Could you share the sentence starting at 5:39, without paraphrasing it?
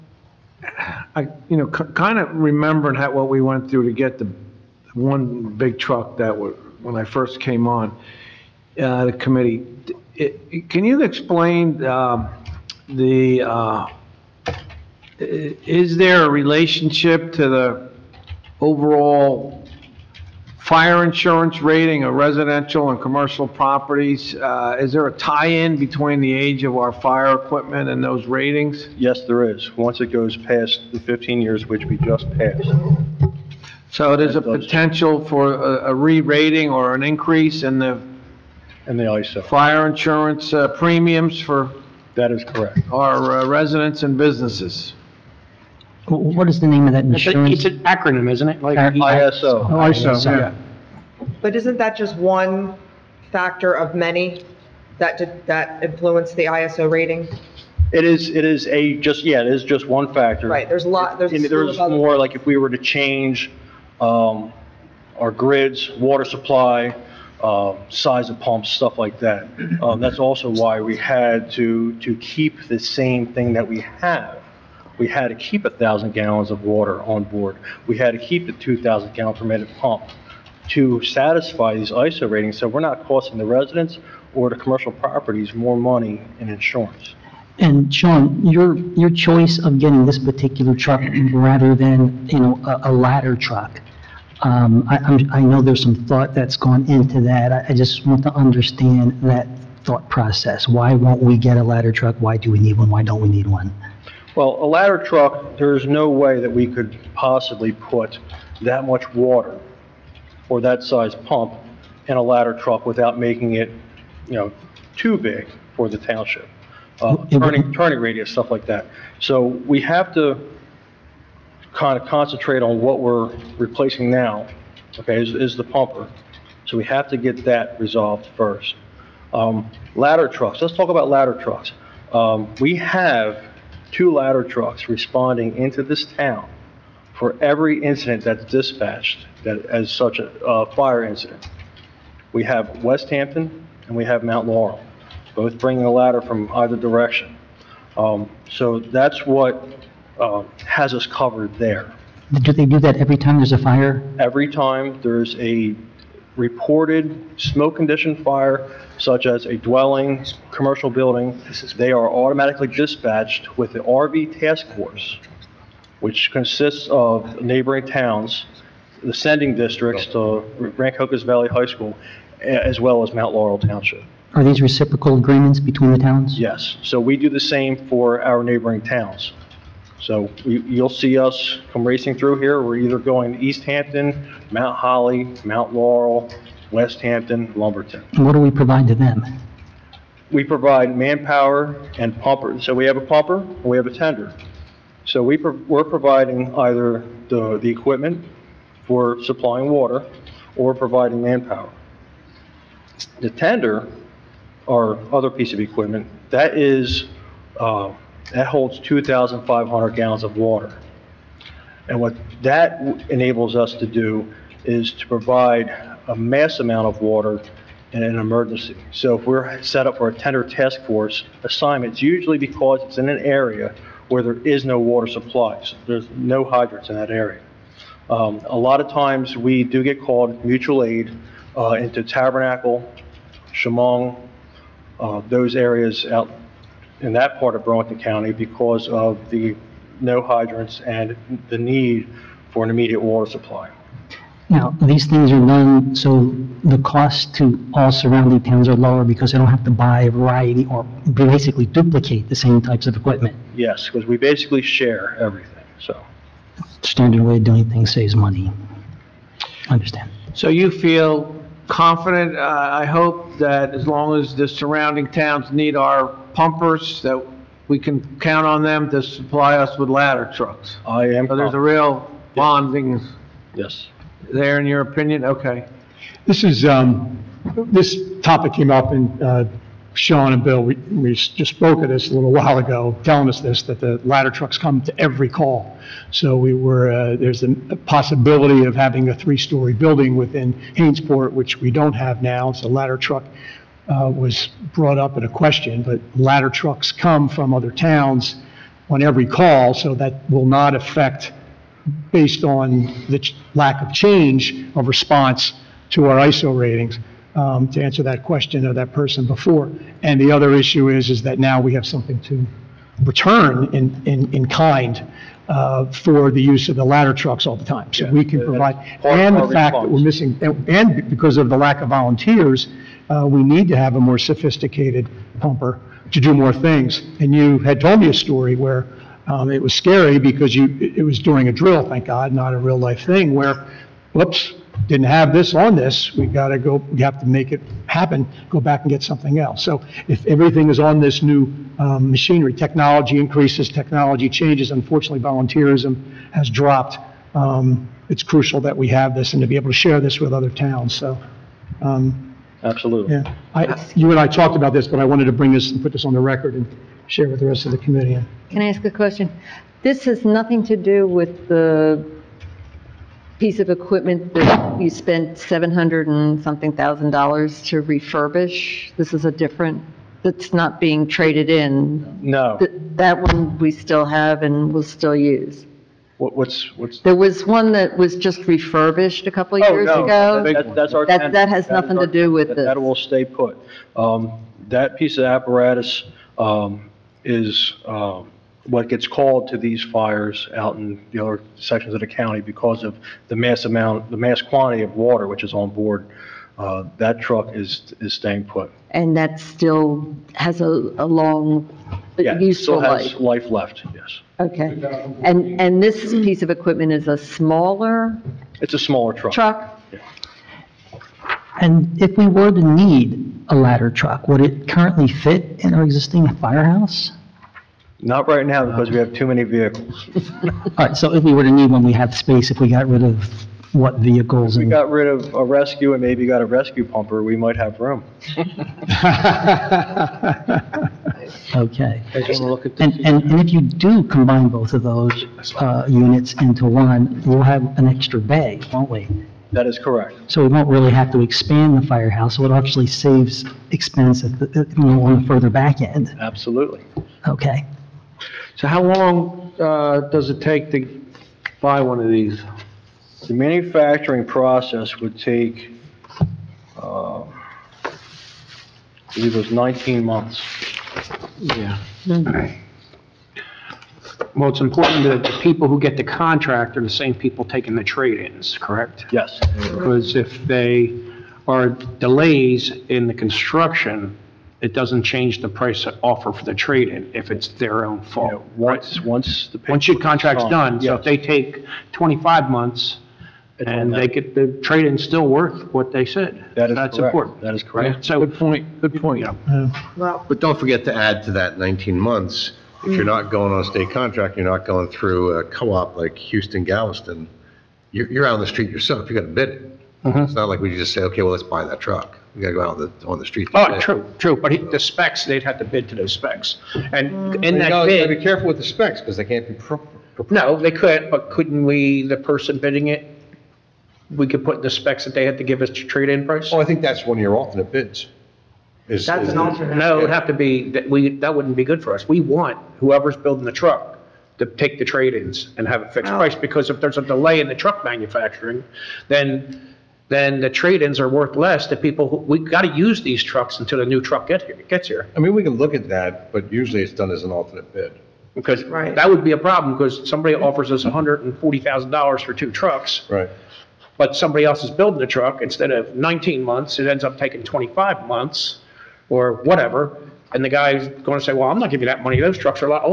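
So if everything is on this new, um, machinery, technology increases, technology changes, unfortunately volunteerism has dropped.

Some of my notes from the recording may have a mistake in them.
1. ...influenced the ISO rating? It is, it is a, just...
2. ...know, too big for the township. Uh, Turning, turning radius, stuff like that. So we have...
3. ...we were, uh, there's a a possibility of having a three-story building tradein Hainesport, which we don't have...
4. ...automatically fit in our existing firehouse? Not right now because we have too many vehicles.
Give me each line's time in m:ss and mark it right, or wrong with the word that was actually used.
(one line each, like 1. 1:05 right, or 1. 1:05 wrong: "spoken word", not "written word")
1. 0:55 right
2. 1:54 right
3. 4:46 wrong: "within", not "tradein"
4. 6:54 wrong: "currently", not "automatically".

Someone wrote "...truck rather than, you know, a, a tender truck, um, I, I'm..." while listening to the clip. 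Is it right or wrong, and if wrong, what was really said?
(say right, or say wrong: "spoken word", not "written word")
wrong: "ladder", not "tender".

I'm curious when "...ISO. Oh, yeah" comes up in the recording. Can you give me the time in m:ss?
0:48.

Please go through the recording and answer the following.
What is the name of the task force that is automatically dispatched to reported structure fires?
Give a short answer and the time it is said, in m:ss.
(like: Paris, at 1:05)
RV task force, at 2:43.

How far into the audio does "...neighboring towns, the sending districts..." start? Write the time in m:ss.
2:47.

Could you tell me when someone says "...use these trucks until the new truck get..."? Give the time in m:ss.
8:52.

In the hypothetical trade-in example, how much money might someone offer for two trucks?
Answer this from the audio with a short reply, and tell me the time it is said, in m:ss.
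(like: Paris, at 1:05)
$140,000, at 9:00.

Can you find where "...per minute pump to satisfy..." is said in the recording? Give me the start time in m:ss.
1:19.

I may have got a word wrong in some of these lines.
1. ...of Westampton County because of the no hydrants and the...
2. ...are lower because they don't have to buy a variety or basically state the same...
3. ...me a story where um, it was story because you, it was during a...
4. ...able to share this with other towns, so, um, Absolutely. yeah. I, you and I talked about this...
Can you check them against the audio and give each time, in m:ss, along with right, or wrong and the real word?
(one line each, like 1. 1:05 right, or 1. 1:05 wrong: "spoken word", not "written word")
1. 3:57 wrong: "Burlington", not "Westampton"
2. 4:08 wrong: "duplicate", not "state"
3. 5:27 wrong: "scary", not "story"
4. 5:49 right.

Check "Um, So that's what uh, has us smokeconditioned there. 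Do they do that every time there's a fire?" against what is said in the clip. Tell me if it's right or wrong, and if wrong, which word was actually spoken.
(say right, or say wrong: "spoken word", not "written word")
wrong: "covered", not "smokeconditioned".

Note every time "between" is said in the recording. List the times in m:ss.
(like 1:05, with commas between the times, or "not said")
0:25, 2:55.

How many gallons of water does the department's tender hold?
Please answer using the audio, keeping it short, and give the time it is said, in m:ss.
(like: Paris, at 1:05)
2,500, at 3:28.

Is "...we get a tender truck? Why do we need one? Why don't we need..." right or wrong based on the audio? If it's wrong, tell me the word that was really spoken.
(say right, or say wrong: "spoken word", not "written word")
wrong: "ladder", not "tender".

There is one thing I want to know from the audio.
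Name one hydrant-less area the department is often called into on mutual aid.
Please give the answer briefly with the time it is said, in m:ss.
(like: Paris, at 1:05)
Tabernacle, at 3:52.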